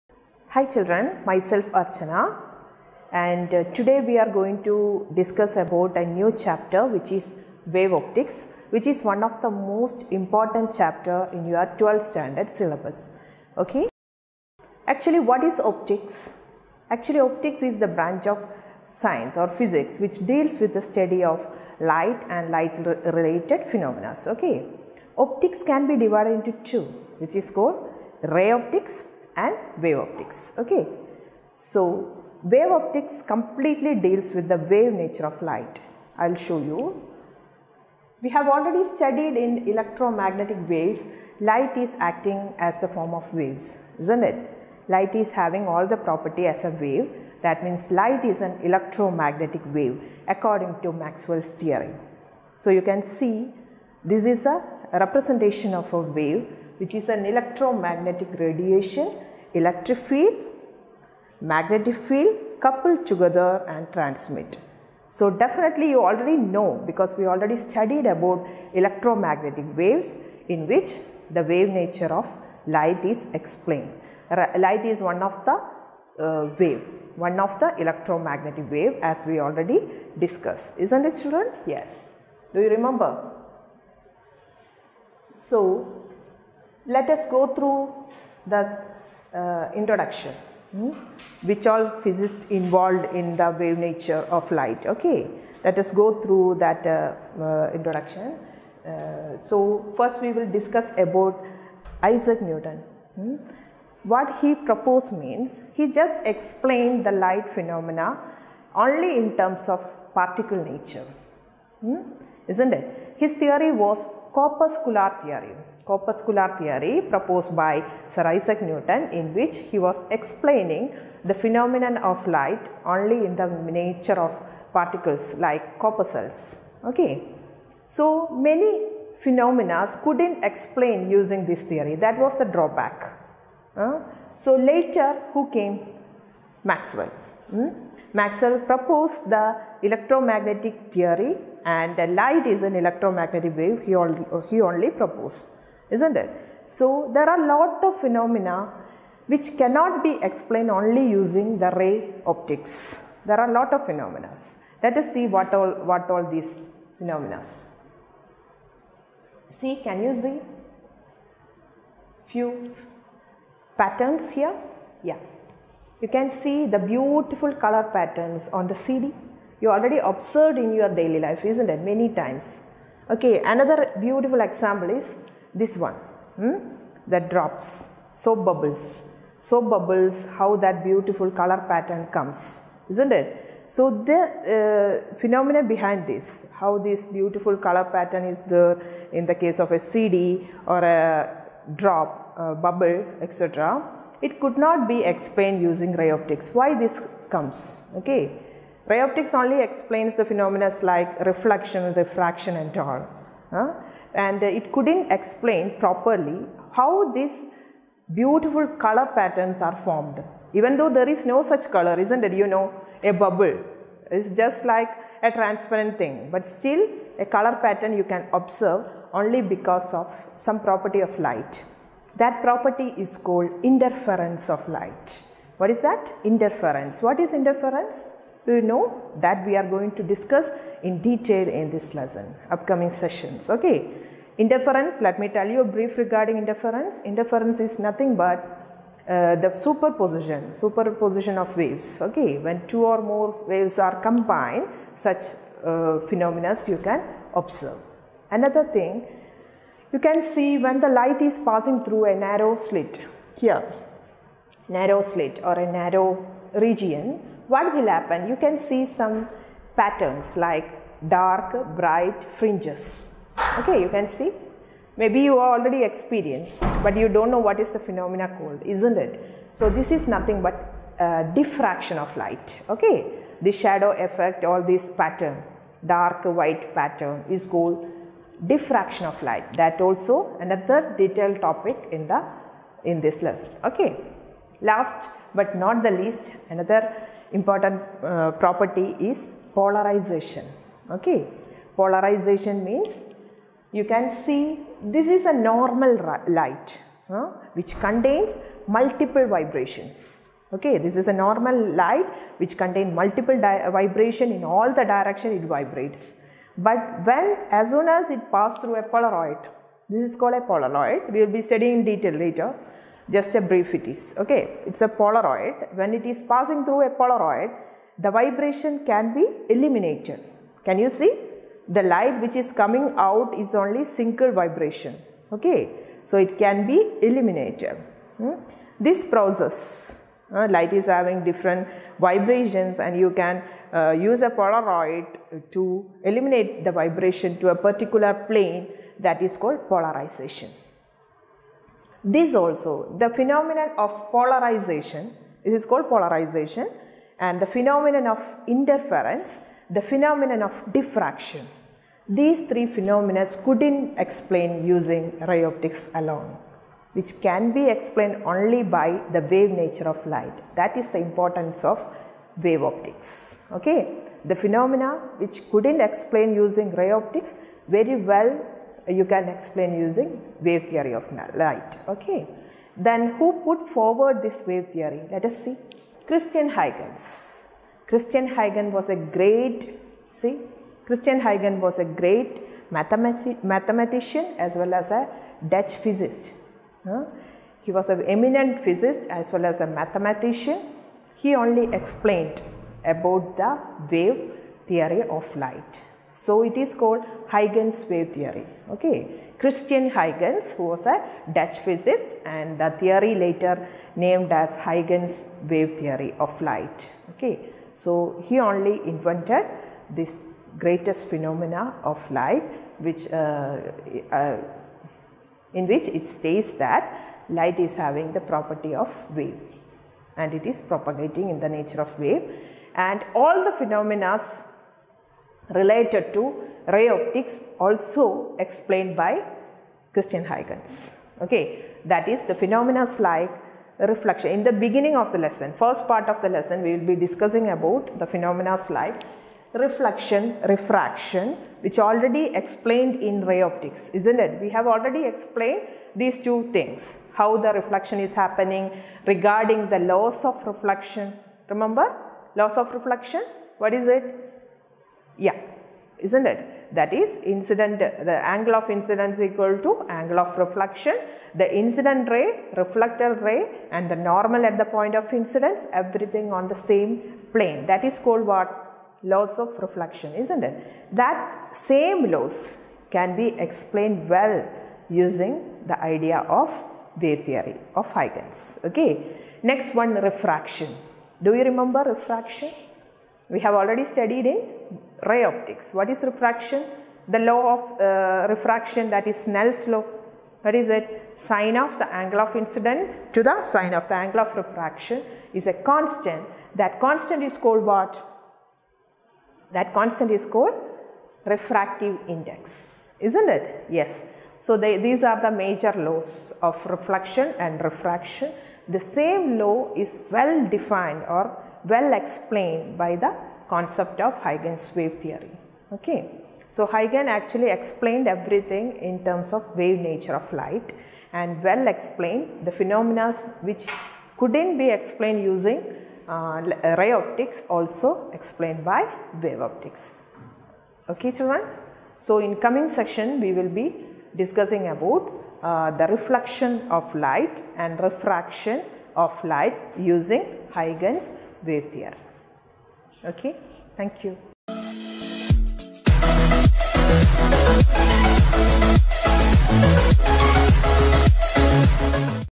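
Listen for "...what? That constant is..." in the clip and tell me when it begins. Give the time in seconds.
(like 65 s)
497 s.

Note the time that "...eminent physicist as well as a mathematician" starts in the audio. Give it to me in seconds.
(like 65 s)
388 s.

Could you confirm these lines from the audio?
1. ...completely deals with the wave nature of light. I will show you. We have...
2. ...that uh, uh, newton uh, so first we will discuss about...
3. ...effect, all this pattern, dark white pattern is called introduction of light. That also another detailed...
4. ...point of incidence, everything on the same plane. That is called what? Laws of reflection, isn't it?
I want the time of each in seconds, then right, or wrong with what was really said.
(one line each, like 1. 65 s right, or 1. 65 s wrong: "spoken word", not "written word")
1. 33 s right
2. 96 s wrong: "introduction", not "newton"
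3. 274 s wrong: "diffraction", not "introduction"
4. 464 s right.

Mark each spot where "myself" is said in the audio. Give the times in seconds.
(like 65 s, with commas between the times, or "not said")
1 s.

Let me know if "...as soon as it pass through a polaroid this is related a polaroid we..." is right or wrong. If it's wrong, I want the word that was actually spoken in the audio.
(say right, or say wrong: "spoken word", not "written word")
wrong: "called", not "related".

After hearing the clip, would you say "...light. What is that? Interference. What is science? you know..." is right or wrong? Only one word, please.
wrong.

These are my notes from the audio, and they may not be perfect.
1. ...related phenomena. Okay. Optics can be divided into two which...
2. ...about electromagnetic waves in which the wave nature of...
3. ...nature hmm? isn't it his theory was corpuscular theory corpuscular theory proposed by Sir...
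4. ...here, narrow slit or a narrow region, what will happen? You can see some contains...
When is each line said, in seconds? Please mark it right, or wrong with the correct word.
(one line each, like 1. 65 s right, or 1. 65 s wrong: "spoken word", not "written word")
1. 23 s right
2. 68 s right
3. 110 s right
4. 253 s wrong: "patterns", not "contains".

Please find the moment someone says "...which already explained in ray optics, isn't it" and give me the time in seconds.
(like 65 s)
441 s.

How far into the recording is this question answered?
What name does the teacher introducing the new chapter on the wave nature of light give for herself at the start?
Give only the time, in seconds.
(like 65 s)
1 s.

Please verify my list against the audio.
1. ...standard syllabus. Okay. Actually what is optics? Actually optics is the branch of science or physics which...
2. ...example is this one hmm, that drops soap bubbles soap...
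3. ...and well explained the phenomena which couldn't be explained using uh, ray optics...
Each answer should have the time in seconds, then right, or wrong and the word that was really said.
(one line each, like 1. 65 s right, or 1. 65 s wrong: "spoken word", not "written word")
1. 12 s right
2. 174 s right
3. 521 s right.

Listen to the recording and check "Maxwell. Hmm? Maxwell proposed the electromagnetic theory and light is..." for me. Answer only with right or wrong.
right.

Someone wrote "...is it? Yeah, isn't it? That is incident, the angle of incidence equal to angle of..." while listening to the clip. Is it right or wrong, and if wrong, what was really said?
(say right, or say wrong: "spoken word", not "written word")
right.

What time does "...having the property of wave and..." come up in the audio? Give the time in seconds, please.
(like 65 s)
417 s.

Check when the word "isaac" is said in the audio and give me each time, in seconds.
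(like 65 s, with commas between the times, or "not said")
102 s, 118 s.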